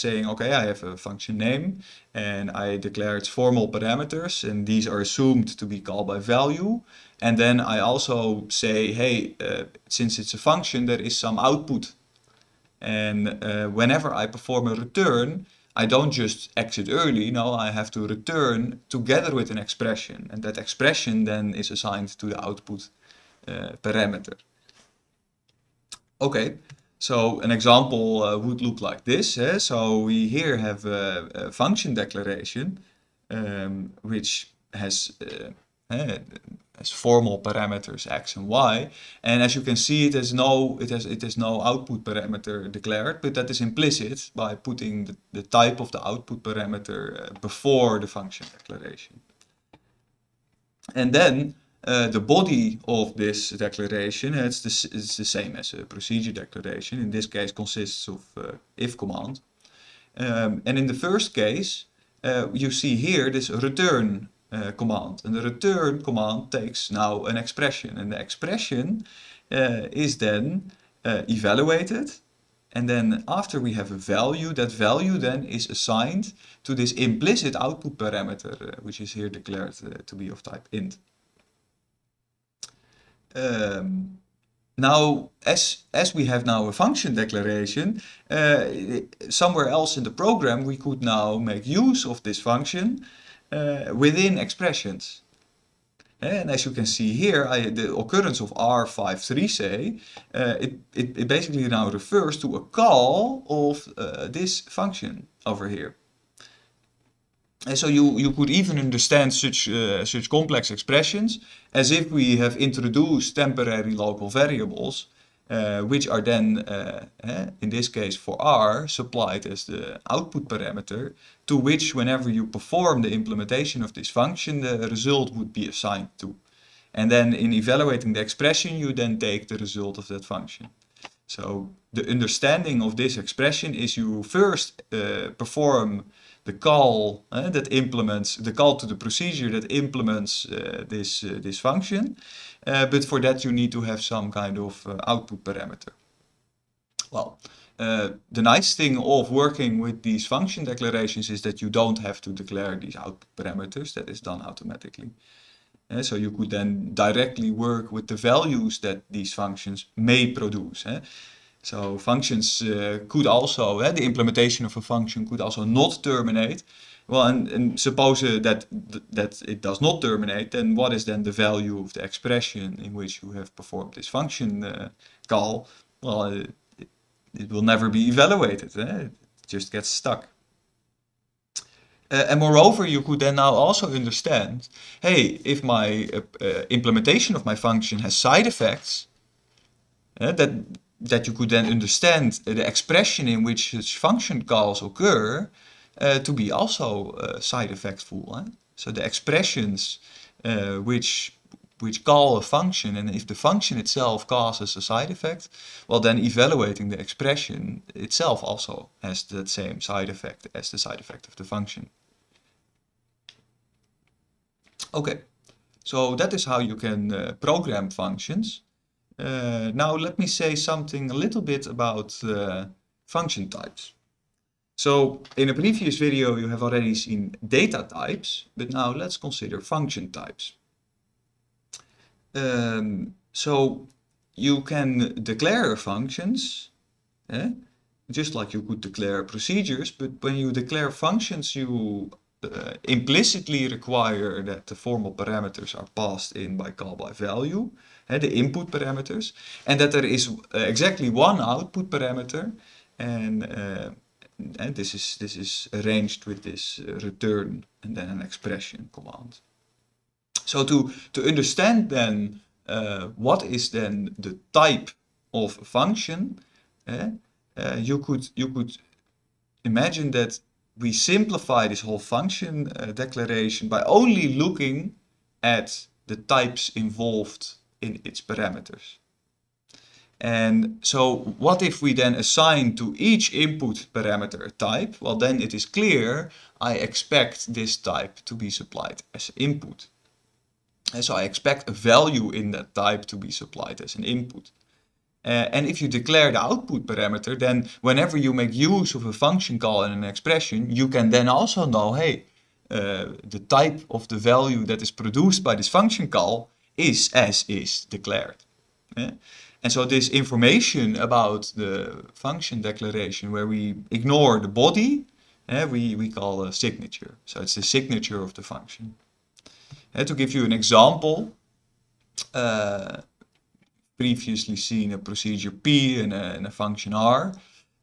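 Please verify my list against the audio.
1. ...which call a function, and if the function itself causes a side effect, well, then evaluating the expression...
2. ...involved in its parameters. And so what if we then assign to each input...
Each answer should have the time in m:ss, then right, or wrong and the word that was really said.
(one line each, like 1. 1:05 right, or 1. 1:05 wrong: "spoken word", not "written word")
1. 3:21 right
2. 4:36 right.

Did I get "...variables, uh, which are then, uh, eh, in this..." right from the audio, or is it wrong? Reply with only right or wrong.
right.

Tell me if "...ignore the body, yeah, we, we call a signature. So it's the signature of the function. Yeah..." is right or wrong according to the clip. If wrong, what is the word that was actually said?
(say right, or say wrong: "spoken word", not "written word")
right.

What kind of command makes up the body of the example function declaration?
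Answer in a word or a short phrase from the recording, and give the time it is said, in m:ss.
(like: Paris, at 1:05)
if command, at 0:58.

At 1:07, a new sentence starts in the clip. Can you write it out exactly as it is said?
And the expression uh, is then evaluated.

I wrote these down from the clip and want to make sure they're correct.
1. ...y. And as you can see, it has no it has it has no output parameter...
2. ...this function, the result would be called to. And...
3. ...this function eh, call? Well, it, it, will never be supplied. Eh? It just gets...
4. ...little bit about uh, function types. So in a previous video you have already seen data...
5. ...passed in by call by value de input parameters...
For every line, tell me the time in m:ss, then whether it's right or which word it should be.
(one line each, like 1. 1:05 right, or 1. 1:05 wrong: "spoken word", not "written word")
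1. 0:38 right
2. 2:03 wrong: "assigned", not "called"
3. 2:53 wrong: "evaluated", not "supplied"
4. 3:41 right
5. 4:05 right.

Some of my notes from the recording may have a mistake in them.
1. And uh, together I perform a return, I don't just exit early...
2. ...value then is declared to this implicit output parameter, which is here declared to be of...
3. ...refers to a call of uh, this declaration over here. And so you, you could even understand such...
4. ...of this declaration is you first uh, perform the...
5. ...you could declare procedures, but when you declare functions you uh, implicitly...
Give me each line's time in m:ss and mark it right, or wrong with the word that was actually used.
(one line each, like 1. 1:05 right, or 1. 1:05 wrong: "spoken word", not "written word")
1. 0:12 wrong: "whenever", not "together"
2. 1:14 wrong: "assigned", not "declared"
3. 1:41 wrong: "function", not "declaration"
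4. 2:12 wrong: "expression", not "declaration"
5. 3:58 right.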